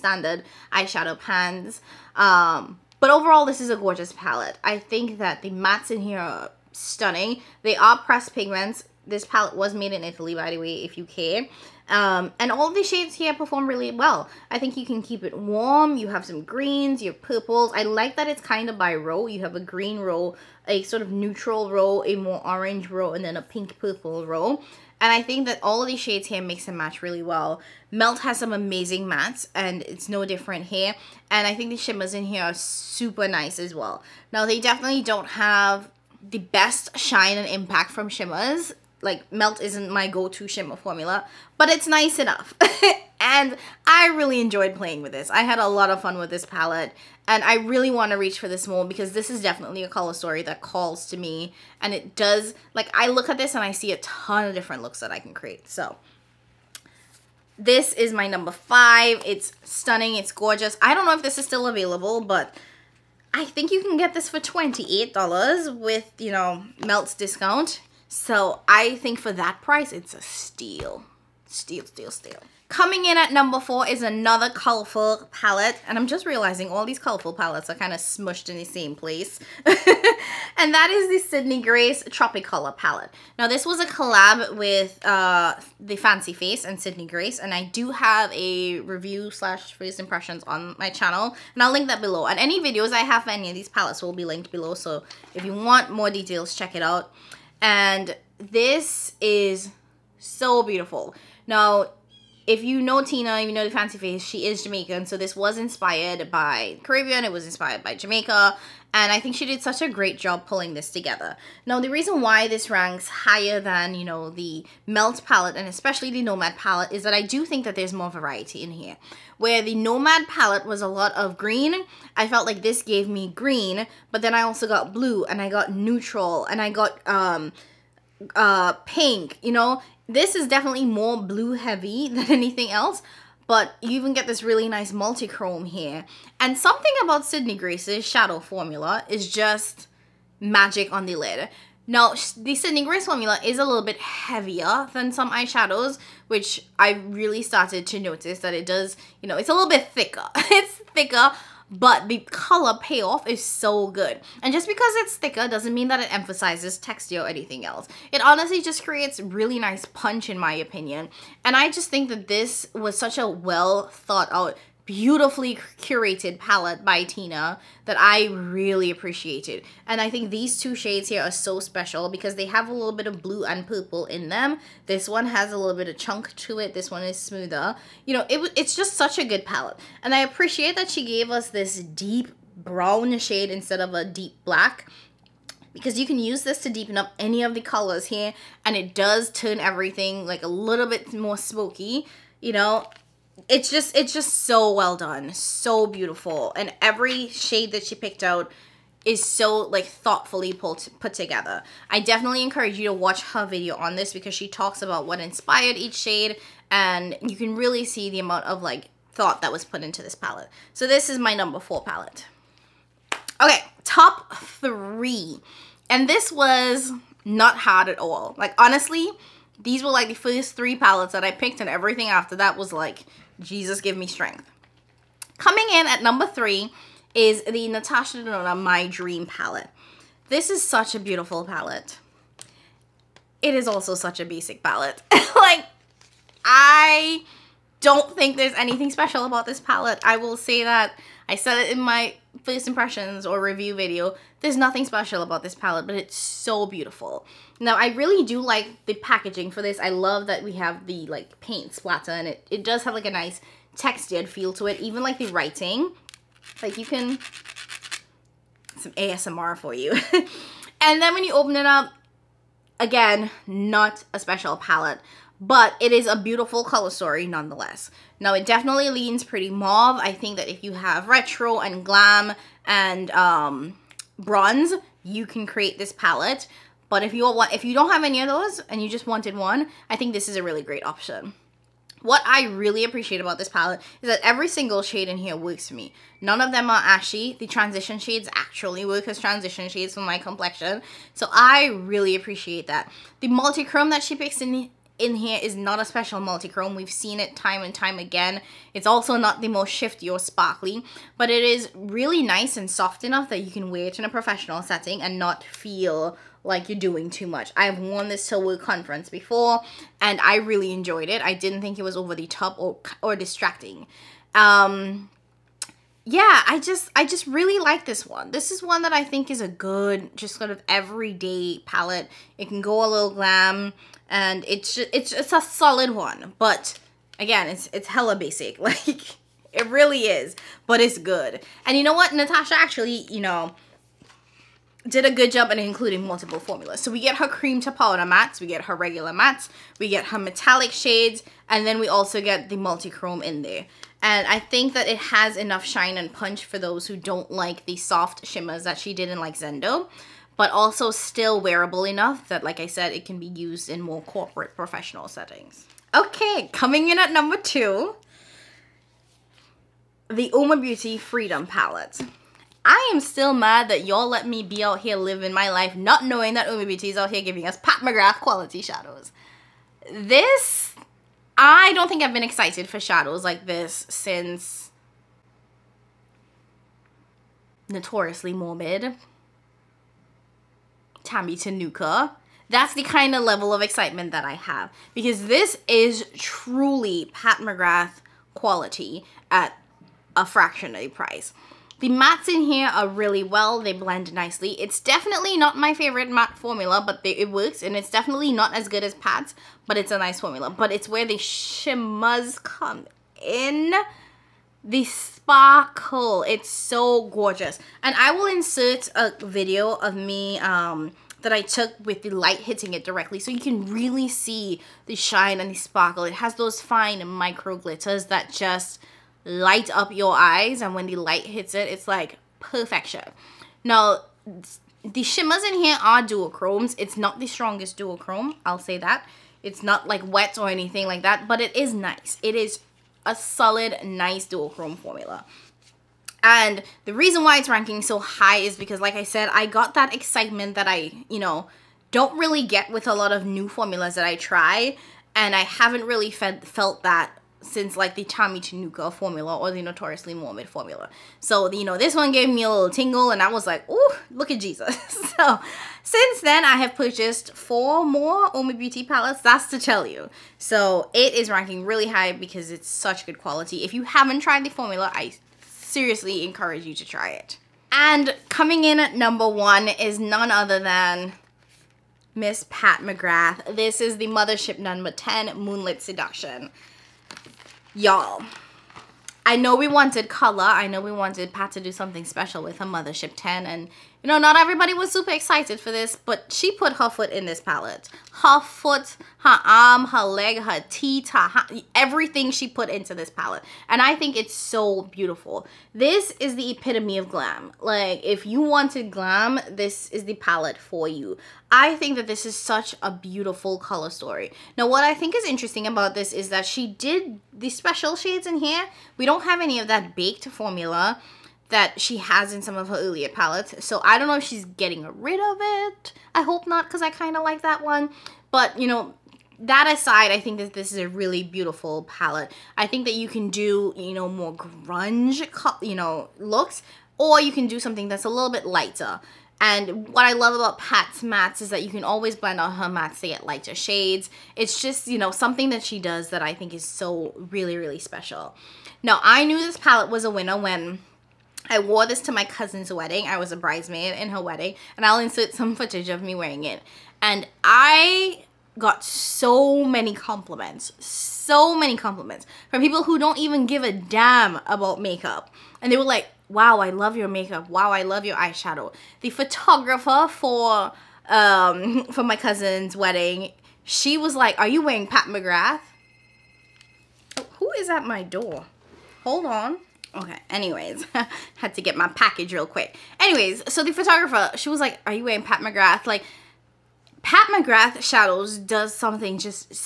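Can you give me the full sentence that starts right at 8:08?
Her foot, her arm, her leg, her teeth, her, her, everything she put into this palette.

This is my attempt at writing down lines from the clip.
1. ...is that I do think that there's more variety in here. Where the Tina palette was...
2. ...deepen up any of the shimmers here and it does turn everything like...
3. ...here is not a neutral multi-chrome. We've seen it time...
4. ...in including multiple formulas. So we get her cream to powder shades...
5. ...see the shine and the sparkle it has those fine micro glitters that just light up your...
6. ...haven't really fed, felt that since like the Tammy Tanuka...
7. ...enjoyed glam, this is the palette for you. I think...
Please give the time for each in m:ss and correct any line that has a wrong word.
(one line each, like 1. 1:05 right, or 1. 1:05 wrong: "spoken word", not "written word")
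1. 1:56 wrong: "Nomad", not "Tina"
2. 3:06 wrong: "colors", not "shimmers"
3. 4:55 wrong: "special", not "neutral"
4. 5:35 wrong: "mattes", not "shades"
5. 6:54 right
6. 7:25 right
7. 8:18 wrong: "wanted", not "enjoyed".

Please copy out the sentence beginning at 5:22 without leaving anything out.
It can go a little glam and it's just, it's, it's a solid one, but again, it's, it's hella basic.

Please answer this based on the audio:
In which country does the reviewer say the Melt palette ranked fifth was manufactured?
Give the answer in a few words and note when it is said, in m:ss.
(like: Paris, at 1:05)
Italy, at 0:10.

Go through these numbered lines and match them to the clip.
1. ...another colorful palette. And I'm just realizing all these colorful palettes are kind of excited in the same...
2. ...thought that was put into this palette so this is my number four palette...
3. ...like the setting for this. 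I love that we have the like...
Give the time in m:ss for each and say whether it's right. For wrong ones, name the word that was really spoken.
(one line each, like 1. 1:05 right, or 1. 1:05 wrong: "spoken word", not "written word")
1. 1:14 wrong: "smushed", not "excited"
2. 3:29 right
3. 4:08 wrong: "packaging", not "setting".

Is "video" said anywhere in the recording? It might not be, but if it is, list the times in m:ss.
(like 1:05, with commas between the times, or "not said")
1:32, 3:23, 4:03, 6:49.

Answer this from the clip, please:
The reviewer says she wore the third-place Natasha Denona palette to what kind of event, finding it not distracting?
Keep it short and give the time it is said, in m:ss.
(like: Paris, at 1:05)
a conference, at 5:08.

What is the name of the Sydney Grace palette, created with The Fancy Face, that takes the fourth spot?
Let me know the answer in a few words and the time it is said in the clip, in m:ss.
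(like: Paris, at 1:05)
Tropicolor, at 1:22.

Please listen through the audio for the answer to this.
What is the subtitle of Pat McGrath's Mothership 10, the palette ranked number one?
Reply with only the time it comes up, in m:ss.
7:55.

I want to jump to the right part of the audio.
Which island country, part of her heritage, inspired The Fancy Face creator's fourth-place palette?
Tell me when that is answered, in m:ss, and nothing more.
1:47.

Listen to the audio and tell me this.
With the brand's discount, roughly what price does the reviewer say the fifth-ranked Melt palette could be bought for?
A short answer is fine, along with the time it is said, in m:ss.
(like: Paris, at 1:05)
$28, at 1:04.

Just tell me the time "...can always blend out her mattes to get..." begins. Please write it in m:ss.
8:51.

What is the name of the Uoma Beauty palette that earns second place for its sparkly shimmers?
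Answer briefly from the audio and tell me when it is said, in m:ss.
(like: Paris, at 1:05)
Freedom Palette, at 6:00.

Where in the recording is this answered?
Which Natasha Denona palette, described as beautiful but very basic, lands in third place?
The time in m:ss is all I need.
3:48.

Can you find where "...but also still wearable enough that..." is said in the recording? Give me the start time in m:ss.
5:50.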